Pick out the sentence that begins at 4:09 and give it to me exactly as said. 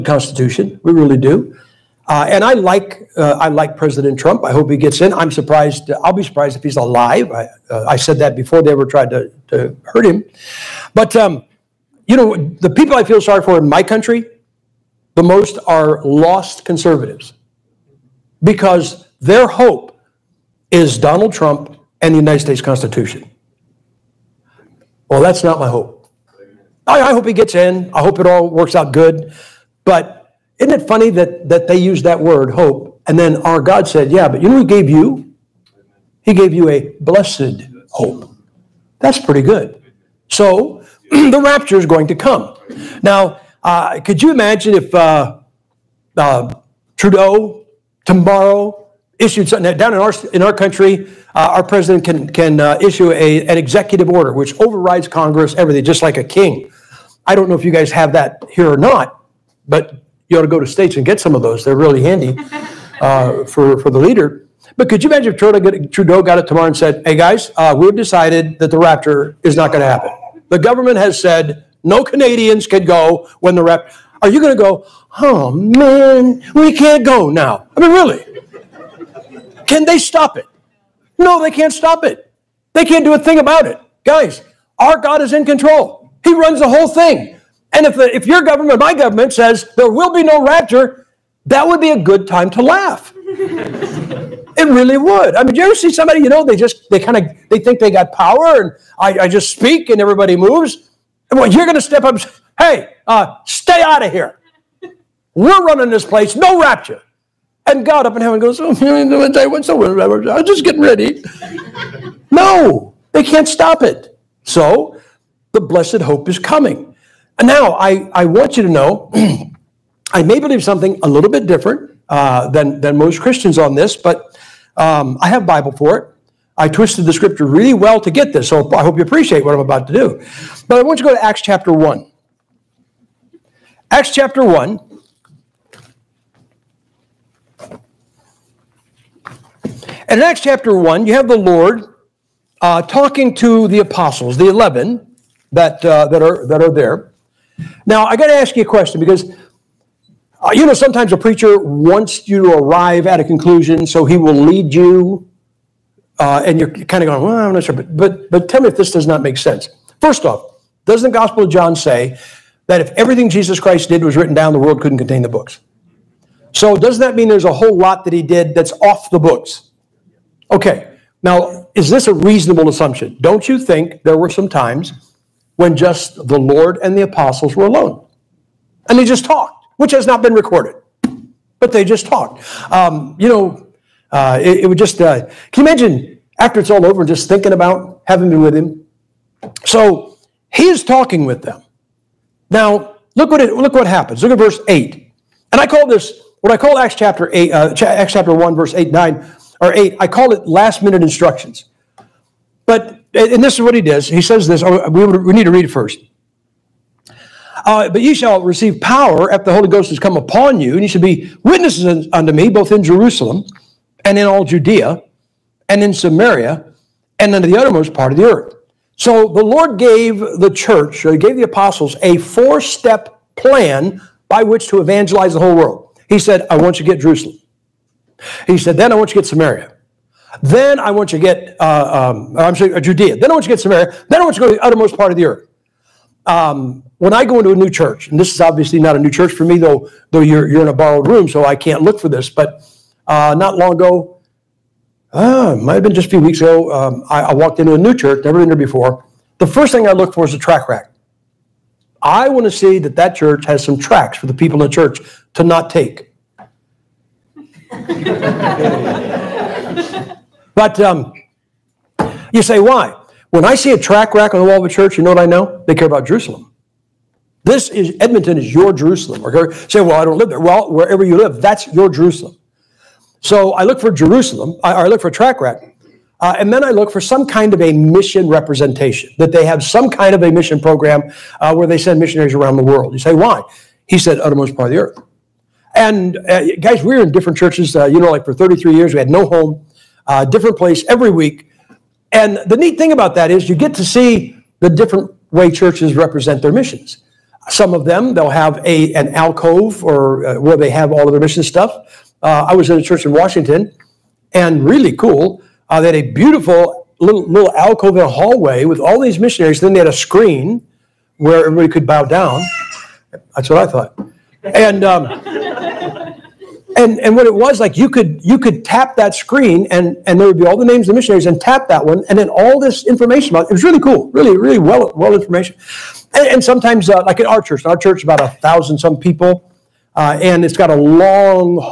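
The first thing I look for is a tract rack.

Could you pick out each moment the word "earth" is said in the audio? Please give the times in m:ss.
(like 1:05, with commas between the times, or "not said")
3:38, 3:55, 4:44.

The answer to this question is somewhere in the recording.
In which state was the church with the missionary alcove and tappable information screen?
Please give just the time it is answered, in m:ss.
5:03.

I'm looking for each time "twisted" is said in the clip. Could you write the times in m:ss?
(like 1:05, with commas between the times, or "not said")
2:06.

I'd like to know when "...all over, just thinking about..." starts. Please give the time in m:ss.
3:06.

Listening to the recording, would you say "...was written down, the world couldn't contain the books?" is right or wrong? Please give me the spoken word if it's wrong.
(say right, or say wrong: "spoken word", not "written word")
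right.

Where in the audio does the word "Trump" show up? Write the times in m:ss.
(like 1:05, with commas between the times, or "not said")
0:04, 0:21.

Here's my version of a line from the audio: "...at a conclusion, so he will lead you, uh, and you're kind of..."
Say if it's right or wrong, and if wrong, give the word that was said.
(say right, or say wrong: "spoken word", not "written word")
right.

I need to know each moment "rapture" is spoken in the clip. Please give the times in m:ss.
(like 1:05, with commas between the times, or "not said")
0:41, 1:08, 1:30, 1:46.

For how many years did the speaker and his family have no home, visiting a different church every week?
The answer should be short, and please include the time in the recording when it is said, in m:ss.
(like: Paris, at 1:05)
33, at 4:48.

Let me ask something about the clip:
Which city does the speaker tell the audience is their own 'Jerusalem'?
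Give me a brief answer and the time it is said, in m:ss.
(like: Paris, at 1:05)
Edmonton, at 4:28.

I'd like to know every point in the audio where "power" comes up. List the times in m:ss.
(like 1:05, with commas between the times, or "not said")
1:38, 3:28.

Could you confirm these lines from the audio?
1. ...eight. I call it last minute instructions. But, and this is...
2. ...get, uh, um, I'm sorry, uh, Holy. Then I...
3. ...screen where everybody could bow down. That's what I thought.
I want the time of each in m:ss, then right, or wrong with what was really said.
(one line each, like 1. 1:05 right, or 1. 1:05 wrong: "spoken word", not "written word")
1. 3:19 right
2. 3:51 wrong: "Judea", not "Holy"
3. 5:09 right.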